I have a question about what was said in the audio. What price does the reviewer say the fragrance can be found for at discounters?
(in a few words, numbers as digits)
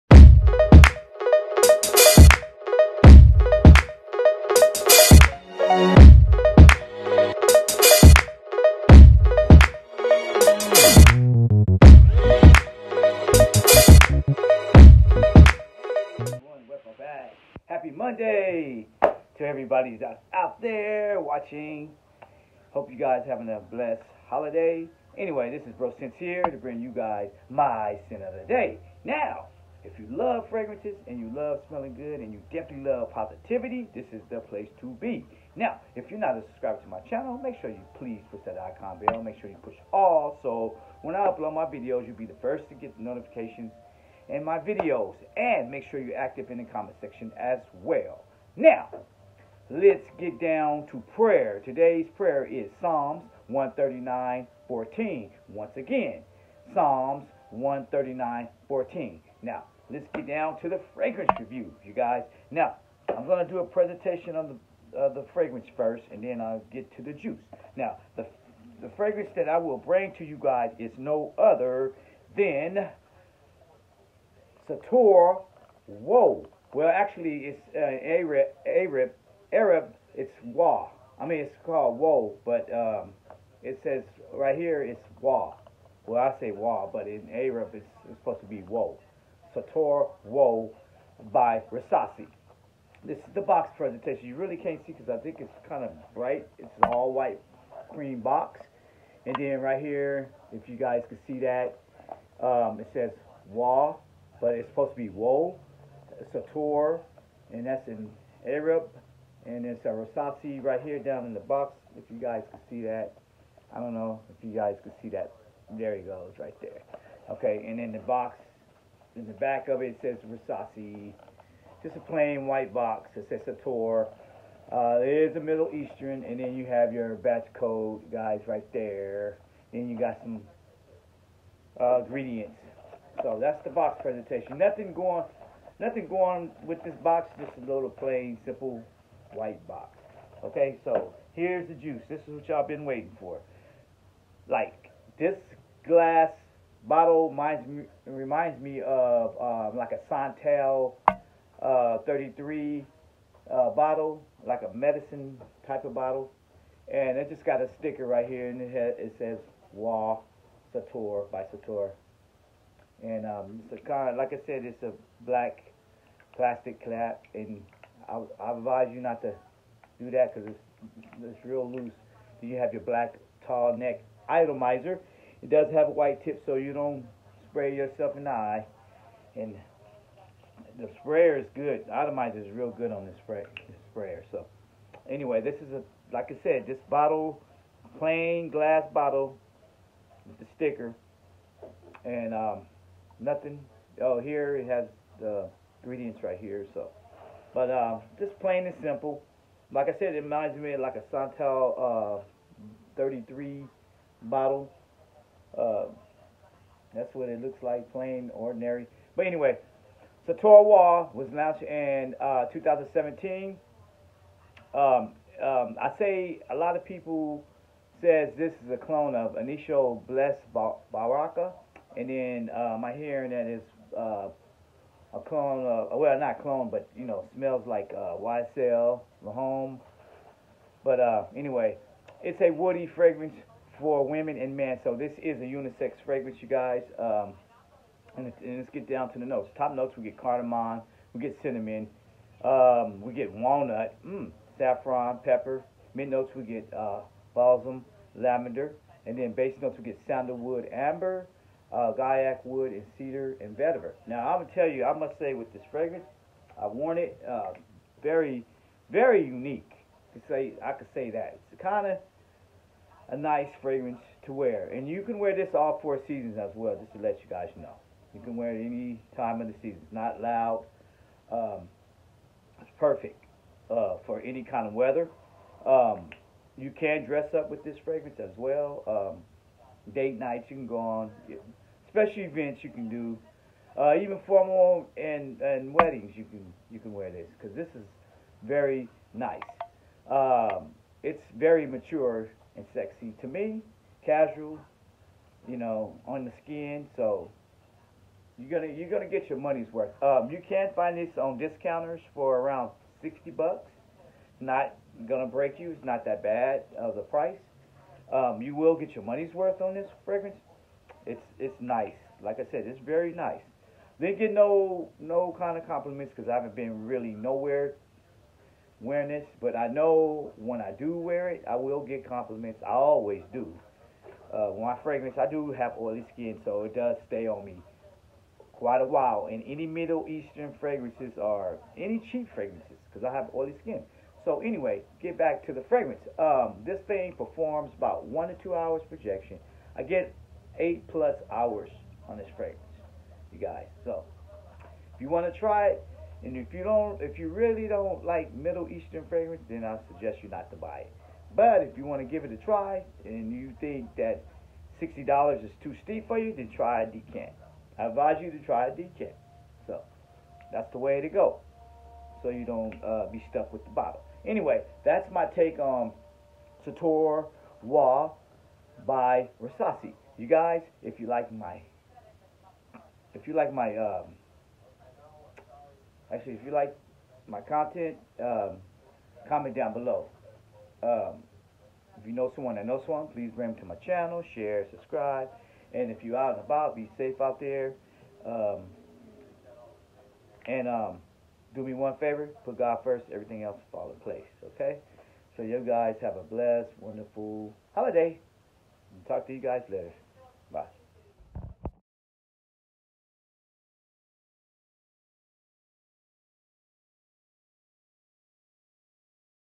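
$60.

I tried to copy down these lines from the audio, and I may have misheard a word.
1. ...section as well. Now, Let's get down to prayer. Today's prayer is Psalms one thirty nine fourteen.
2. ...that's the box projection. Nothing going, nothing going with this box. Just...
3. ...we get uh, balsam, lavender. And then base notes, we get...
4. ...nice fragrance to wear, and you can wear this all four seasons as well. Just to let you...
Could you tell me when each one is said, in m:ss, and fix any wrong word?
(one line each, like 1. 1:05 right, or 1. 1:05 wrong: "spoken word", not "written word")
1. 0:47 right
2. 2:13 wrong: "presentation", not "projection"
3. 4:06 right
4. 4:23 right.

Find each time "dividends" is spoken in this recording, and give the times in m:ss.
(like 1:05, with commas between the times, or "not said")
not said.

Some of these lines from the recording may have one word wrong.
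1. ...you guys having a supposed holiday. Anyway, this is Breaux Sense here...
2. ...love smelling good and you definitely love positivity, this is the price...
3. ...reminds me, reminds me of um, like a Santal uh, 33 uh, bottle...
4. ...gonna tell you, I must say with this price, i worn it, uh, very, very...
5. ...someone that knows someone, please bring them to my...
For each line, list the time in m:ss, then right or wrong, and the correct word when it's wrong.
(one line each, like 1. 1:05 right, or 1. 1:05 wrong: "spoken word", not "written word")
1. 0:22 wrong: "blessed", not "supposed"
2. 0:31 wrong: "place", not "price"
3. 2:27 right
4. 4:14 wrong: "fragrance", not "price"
5. 6:22 right.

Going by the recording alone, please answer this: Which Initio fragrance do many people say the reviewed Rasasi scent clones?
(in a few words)
Bless Baraka.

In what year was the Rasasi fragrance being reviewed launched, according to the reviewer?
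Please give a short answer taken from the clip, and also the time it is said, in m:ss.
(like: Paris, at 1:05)
2017, at 3:32.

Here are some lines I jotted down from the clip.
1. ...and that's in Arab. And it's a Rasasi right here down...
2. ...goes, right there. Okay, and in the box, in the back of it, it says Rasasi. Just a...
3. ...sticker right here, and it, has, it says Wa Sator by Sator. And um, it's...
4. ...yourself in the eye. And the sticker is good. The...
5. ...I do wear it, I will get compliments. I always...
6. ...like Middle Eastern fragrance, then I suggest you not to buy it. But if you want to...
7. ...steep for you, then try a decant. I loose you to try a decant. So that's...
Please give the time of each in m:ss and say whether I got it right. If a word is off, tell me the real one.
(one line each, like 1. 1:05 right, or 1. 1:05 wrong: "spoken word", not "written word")
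1. 1:47 right
2. 1:56 right
3. 2:37 right
4. 2:57 wrong: "sprayer", not "sticker"
5. 5:20 right
6. 5:48 right
7. 5:55 wrong: "advise", not "loose".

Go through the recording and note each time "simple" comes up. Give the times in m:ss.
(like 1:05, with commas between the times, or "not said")
2:18, 3:18.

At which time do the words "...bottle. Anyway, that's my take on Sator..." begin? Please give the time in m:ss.
6:03.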